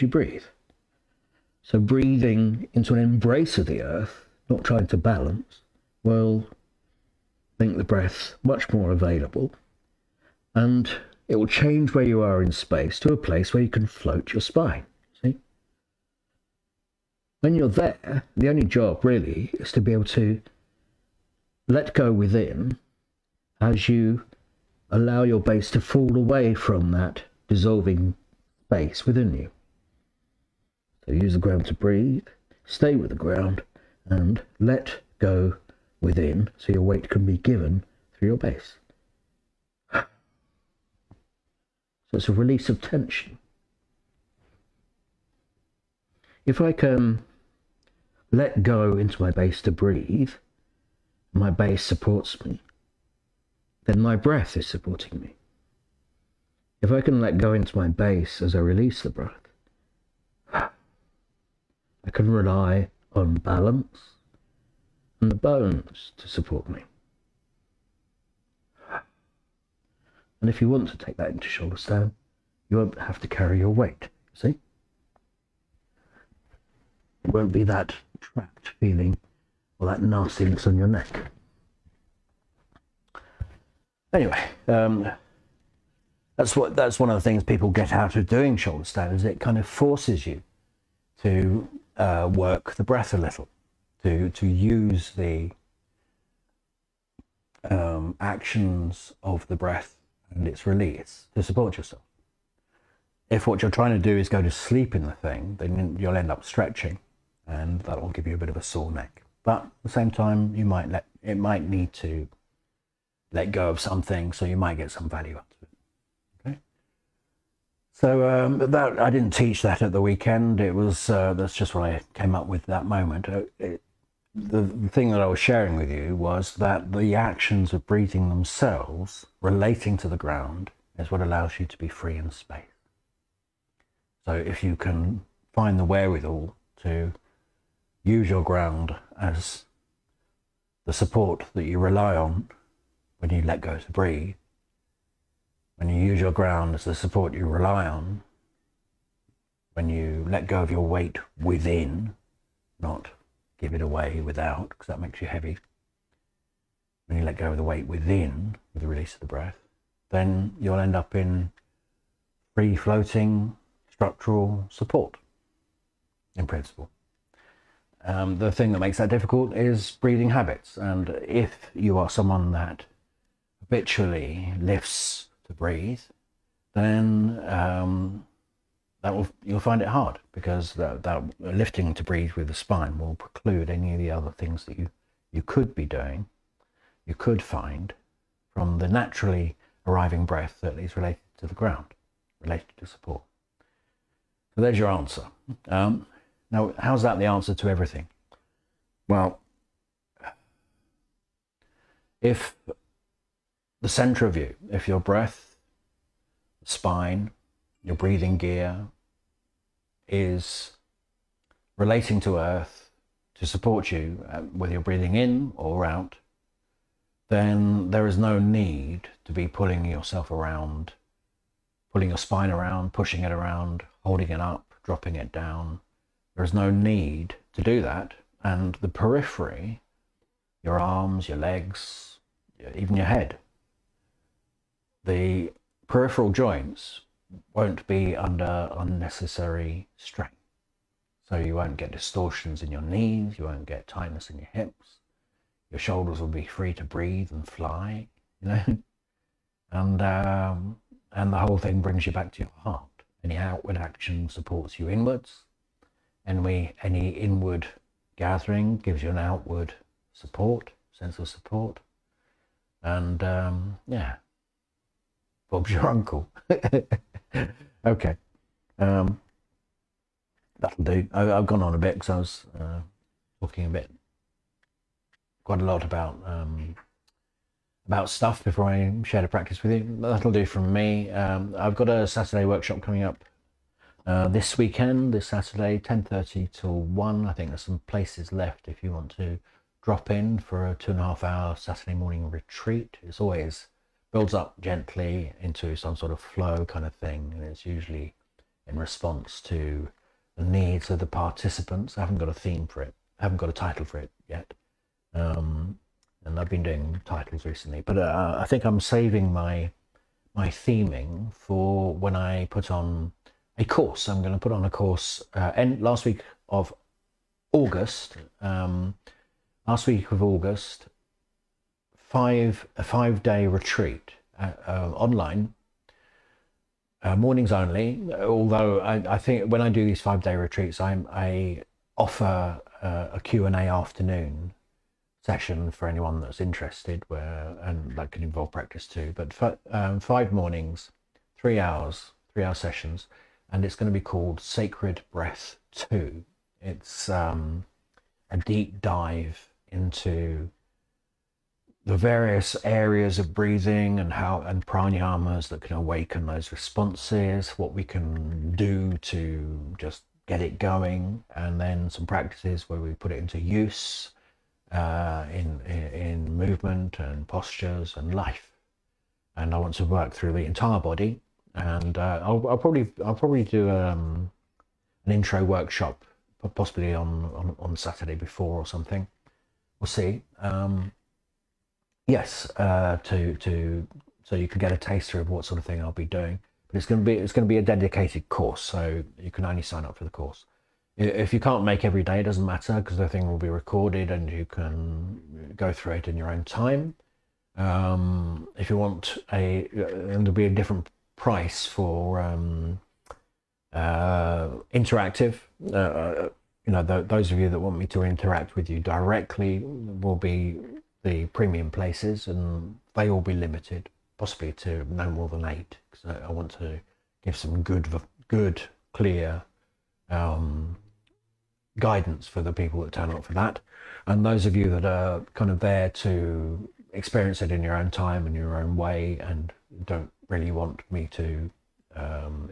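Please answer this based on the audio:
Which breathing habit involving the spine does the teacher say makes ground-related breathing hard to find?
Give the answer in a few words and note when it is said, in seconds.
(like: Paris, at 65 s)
Lifting to breathe, at 174 s.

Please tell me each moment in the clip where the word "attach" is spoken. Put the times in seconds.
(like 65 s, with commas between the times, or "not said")
not said.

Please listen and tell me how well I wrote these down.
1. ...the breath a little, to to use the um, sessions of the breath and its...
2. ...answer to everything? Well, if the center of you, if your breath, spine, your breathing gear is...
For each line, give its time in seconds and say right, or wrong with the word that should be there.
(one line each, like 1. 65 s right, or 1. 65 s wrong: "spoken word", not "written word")
1. 92 s wrong: "actions", not "sessions"
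2. 197 s right.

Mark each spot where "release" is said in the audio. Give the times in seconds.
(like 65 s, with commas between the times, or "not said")
42 s, 58 s, 100 s, 158 s.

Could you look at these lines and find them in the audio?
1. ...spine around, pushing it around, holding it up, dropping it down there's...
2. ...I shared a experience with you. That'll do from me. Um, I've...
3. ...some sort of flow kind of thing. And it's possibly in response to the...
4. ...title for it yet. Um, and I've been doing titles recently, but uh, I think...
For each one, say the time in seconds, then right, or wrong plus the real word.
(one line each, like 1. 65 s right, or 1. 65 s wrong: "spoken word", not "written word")
1. 222 s right
2. 278 s wrong: "practice", not "experience"
3. 295 s wrong: "usually", not "possibly"
4. 303 s right.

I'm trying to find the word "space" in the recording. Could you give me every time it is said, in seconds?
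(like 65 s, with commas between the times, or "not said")
12 s, 28 s, 132 s.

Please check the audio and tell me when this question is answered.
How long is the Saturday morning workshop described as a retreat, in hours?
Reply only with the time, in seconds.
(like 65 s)
290 s.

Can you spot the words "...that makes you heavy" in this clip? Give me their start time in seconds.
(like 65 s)
154 s.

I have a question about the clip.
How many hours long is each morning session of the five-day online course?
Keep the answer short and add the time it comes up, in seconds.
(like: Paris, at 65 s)
3, at 342 s.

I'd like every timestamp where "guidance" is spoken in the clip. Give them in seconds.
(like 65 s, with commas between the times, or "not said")
421 s.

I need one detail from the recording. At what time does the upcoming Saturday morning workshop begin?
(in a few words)
10:30.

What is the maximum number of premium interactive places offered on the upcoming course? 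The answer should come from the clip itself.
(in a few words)
8.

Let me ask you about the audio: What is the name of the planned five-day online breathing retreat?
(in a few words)
Sacred Breath 2.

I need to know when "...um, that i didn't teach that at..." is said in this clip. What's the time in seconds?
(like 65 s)
118 s.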